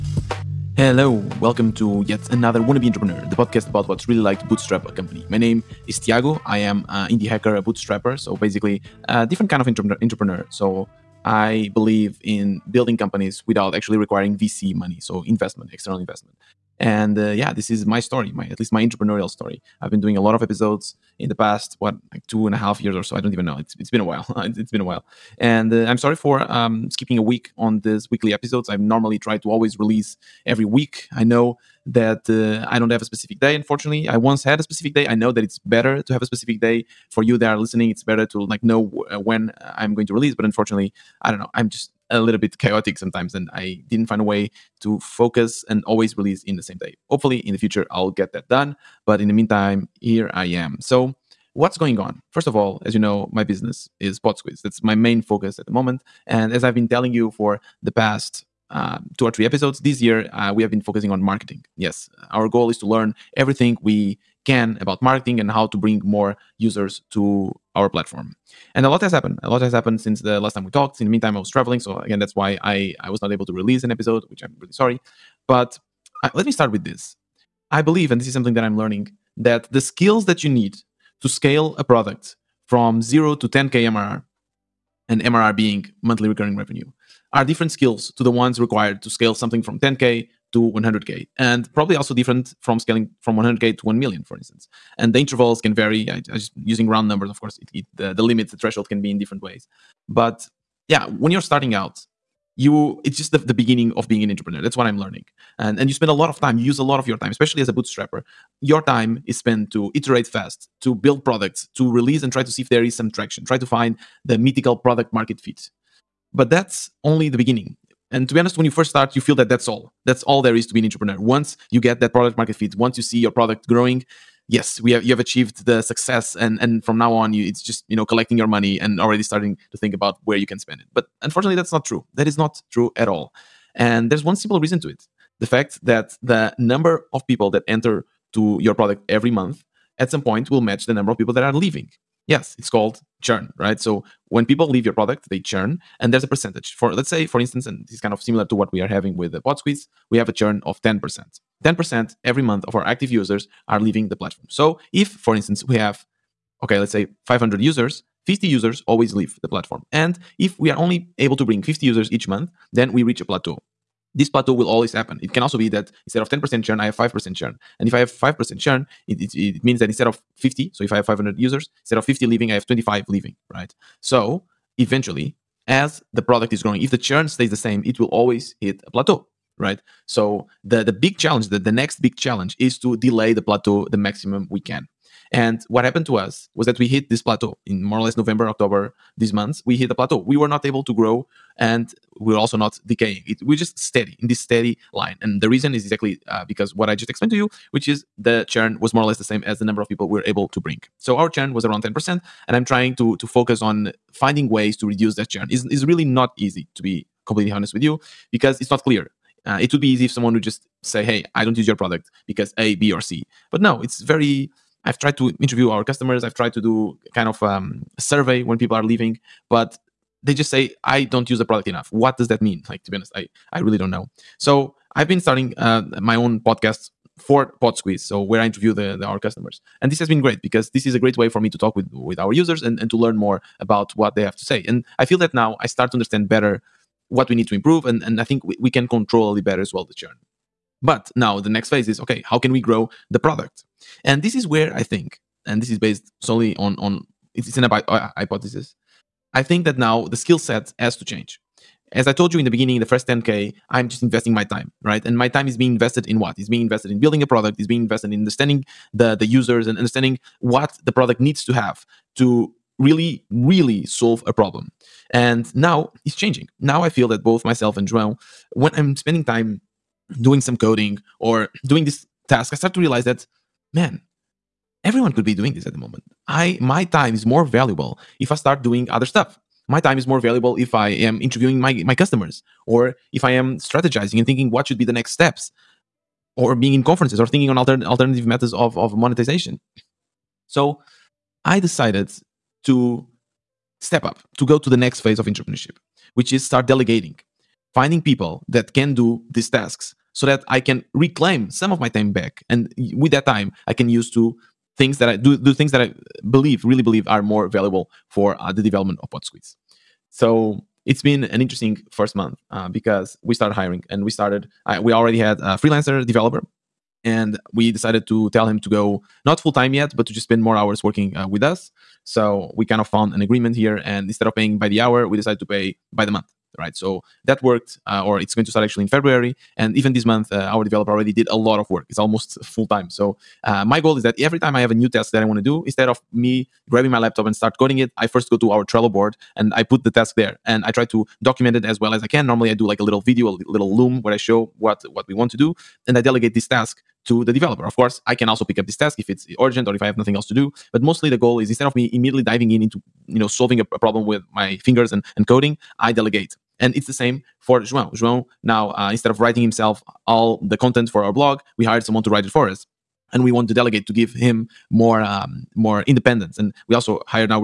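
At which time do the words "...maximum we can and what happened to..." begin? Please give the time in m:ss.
3:03.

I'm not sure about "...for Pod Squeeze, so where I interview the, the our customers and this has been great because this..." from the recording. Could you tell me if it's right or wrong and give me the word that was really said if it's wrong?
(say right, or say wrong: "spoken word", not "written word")
right.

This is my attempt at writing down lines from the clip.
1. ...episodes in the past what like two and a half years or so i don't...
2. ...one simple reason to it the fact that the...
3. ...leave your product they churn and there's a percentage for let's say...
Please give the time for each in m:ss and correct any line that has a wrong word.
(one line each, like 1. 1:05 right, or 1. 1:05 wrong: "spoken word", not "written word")
1. 0:20 right
2. 2:14 right
3. 2:24 right.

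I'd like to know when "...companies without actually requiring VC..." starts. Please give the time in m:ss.
0:12.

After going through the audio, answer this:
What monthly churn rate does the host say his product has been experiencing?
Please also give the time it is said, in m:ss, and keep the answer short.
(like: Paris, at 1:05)
10%, at 2:30.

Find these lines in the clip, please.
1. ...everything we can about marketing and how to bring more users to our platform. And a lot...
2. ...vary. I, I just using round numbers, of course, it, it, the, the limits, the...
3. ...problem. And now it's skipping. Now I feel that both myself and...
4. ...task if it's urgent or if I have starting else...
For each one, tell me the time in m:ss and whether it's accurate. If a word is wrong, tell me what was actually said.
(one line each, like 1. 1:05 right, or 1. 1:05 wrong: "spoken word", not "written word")
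1. 1:03 right
2. 1:35 right
3. 4:24 wrong: "changing", not "skipping"
4. 5:48 wrong: "nothing", not "starting".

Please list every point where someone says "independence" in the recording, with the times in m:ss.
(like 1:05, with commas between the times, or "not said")
6:05.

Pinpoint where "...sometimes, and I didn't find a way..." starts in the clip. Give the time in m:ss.
0:42.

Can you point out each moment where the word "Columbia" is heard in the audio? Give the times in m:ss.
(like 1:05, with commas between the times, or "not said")
not said.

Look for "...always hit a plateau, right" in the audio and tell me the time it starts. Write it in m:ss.
2:58.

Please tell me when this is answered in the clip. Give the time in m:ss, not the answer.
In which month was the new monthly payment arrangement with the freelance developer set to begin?
5:28.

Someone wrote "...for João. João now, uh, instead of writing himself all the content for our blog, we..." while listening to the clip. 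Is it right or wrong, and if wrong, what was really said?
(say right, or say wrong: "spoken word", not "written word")
right.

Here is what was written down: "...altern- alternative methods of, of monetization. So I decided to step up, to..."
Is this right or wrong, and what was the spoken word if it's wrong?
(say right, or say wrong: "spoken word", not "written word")
right.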